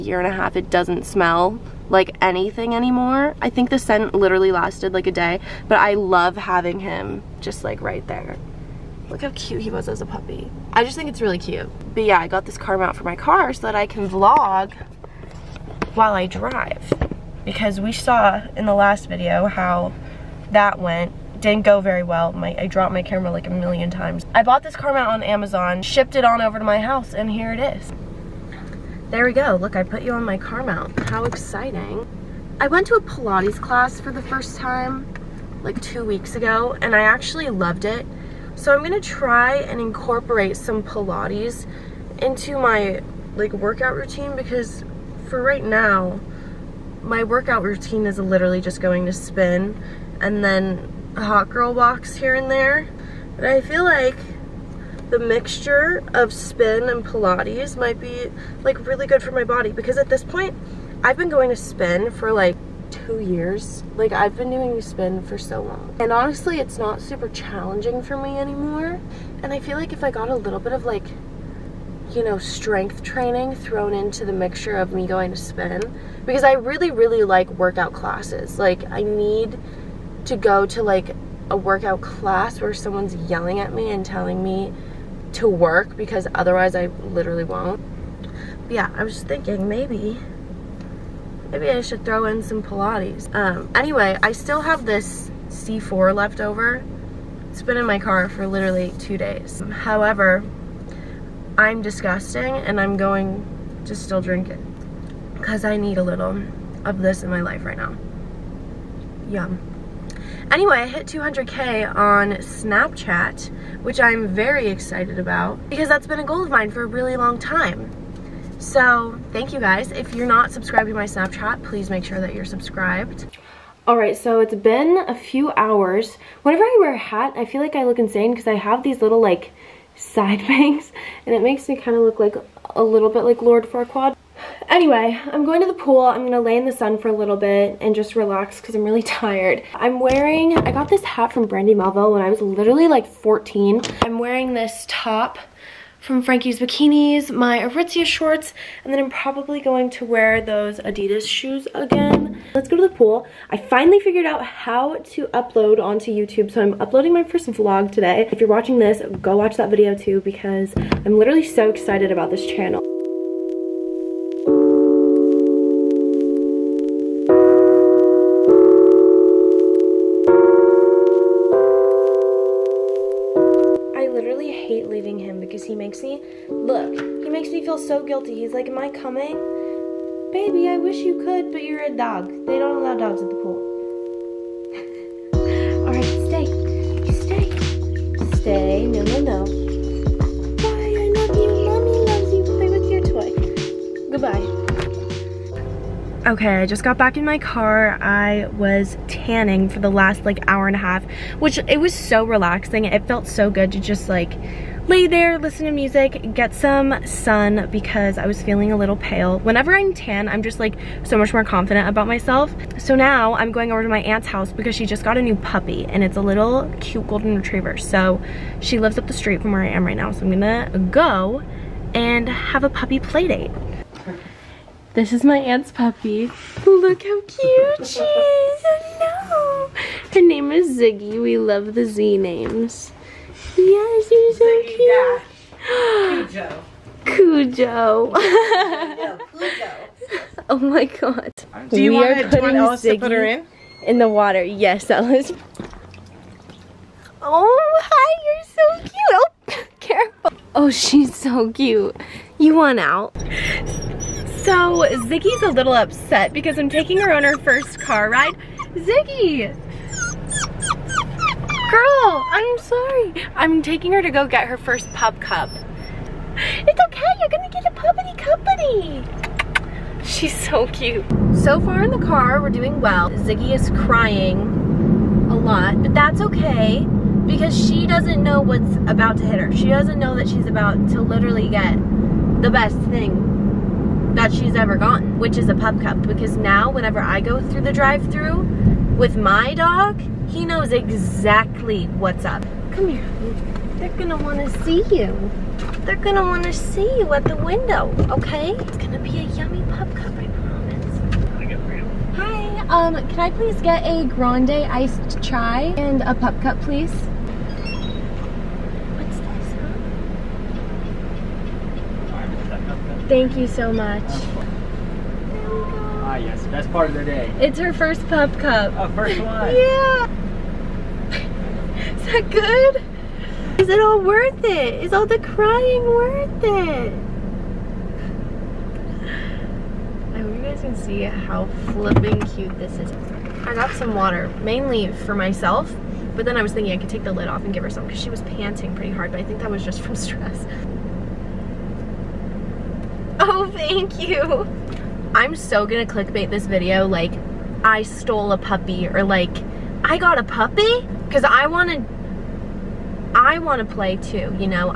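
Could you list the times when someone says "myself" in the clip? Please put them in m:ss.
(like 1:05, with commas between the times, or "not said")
3:32, 5:35.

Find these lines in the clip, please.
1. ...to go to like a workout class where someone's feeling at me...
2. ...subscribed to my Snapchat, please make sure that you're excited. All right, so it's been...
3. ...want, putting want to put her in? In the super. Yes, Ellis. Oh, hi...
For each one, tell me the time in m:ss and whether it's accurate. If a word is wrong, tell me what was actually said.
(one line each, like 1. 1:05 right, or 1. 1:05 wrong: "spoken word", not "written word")
1. 1:20 wrong: "yelling", not "feeling"
2. 2:00 wrong: "subscribed", not "excited"
3. 4:01 wrong: "water", not "super".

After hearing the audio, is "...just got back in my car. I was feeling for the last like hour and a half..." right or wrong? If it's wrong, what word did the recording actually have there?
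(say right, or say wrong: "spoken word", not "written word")
wrong: "tanning", not "feeling".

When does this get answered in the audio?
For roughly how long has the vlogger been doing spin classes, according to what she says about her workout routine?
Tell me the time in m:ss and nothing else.
1:02.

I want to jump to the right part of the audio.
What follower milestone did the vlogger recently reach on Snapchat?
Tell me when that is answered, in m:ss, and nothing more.
1:51.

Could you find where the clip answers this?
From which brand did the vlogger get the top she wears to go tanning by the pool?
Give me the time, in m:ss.
2:26.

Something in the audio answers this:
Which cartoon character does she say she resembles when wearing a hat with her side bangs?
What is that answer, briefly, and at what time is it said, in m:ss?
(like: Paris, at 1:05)
Lord Farquaad, at 2:13.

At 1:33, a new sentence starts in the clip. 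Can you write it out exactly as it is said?
Um, anyway, I still have this C4 left over.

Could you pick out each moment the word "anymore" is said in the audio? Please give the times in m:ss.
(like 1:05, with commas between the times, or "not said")
0:02, 1:08.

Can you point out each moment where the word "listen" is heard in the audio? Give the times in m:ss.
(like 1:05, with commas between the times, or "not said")
3:25.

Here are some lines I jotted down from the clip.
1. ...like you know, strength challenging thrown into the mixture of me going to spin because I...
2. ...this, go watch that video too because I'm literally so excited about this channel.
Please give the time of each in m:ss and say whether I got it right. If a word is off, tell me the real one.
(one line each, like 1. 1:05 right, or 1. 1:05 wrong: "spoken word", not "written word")
1. 1:10 wrong: "training", not "challenging"
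2. 2:38 right.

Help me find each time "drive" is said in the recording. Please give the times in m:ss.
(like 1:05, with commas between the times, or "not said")
0:16, 4:47.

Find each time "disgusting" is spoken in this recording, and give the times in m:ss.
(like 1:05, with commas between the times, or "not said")
1:41.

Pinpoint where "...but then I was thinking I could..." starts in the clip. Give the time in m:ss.
5:36.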